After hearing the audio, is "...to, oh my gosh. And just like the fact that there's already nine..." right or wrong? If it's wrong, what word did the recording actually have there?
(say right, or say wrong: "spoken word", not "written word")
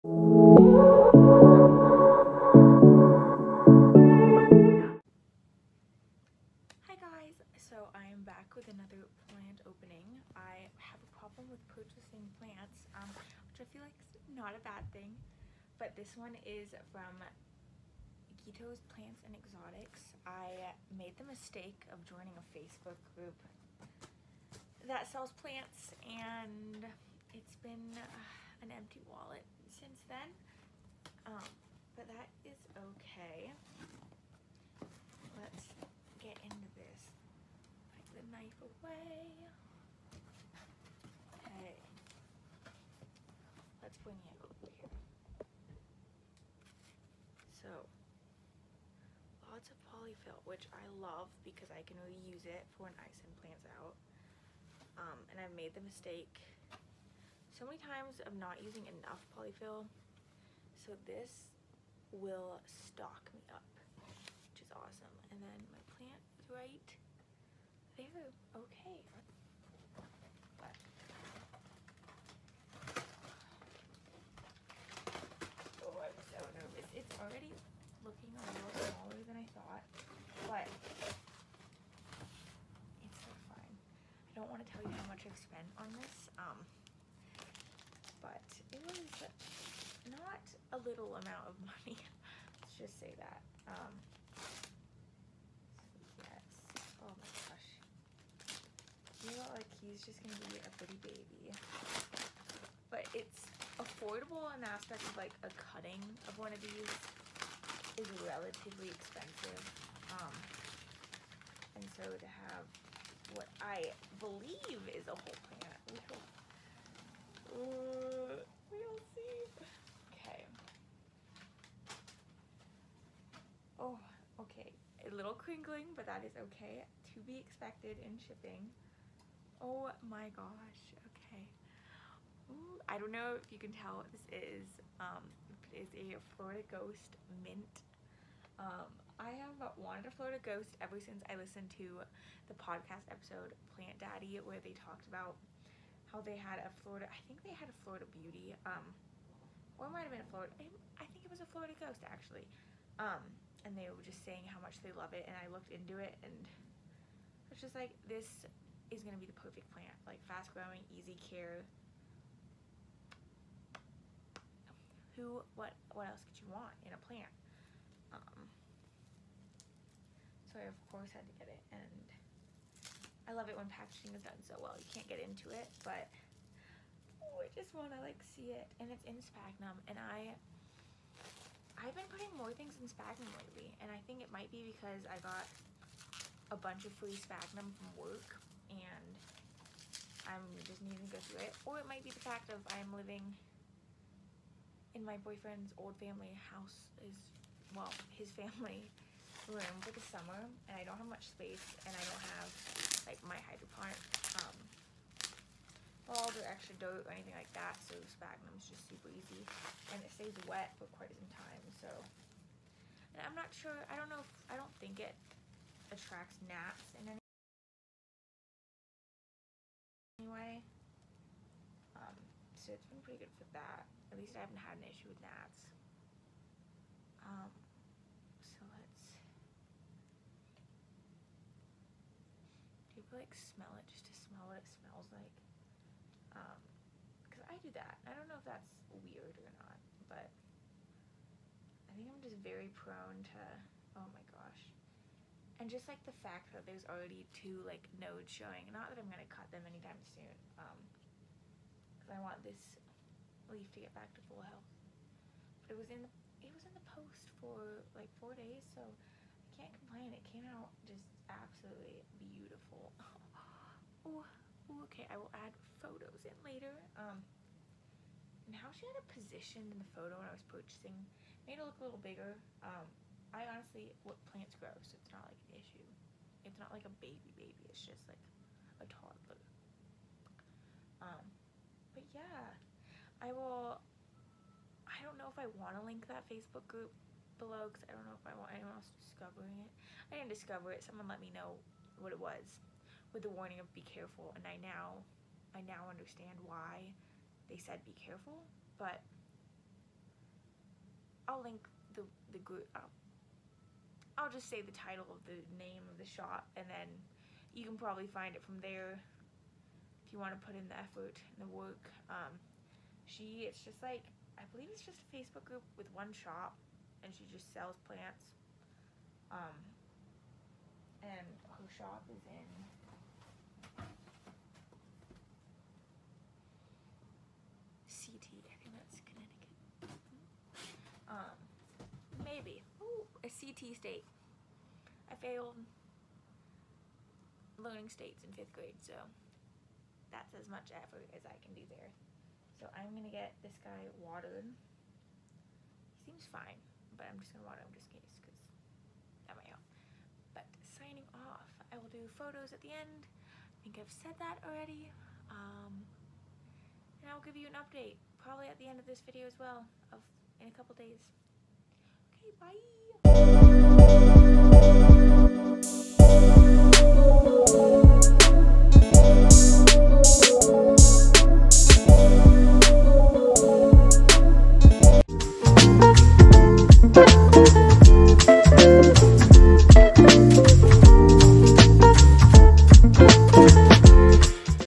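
wrong: "two", not "nine".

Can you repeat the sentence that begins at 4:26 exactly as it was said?
Um, and how she had it positioned in the photo when I was purchasing made it look a little bigger.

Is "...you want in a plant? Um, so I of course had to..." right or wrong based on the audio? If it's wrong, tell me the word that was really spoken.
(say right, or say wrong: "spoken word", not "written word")
right.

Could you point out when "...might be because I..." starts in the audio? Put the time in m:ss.
3:04.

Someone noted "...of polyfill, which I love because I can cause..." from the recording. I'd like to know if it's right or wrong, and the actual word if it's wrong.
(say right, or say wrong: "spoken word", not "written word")
wrong: "reuse", not "cause".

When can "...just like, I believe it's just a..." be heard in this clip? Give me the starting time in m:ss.
5:13.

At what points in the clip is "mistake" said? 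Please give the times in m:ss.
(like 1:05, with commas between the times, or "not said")
0:21, 0:55.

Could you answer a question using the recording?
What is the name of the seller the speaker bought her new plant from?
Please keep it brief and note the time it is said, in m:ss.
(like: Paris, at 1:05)
Gito's Plants and Exotics, at 0:18.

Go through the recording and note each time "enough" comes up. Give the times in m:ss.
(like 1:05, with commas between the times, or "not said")
0:58.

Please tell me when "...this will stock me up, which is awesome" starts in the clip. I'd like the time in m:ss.
1:01.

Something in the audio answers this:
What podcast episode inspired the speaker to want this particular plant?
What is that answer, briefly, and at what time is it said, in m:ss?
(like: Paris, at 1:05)
Plant Daddy, at 2:23.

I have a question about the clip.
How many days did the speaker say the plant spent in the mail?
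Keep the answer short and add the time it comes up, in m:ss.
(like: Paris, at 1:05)
4, at 4:18.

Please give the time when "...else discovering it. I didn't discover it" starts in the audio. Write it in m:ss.
4:48.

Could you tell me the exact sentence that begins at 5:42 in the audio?
So I'm gonna get this guy watered.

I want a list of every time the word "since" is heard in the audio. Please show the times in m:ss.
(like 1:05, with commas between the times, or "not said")
0:29, 2:20.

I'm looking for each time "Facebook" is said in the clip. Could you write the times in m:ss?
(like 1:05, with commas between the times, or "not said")
0:22, 4:46, 5:15.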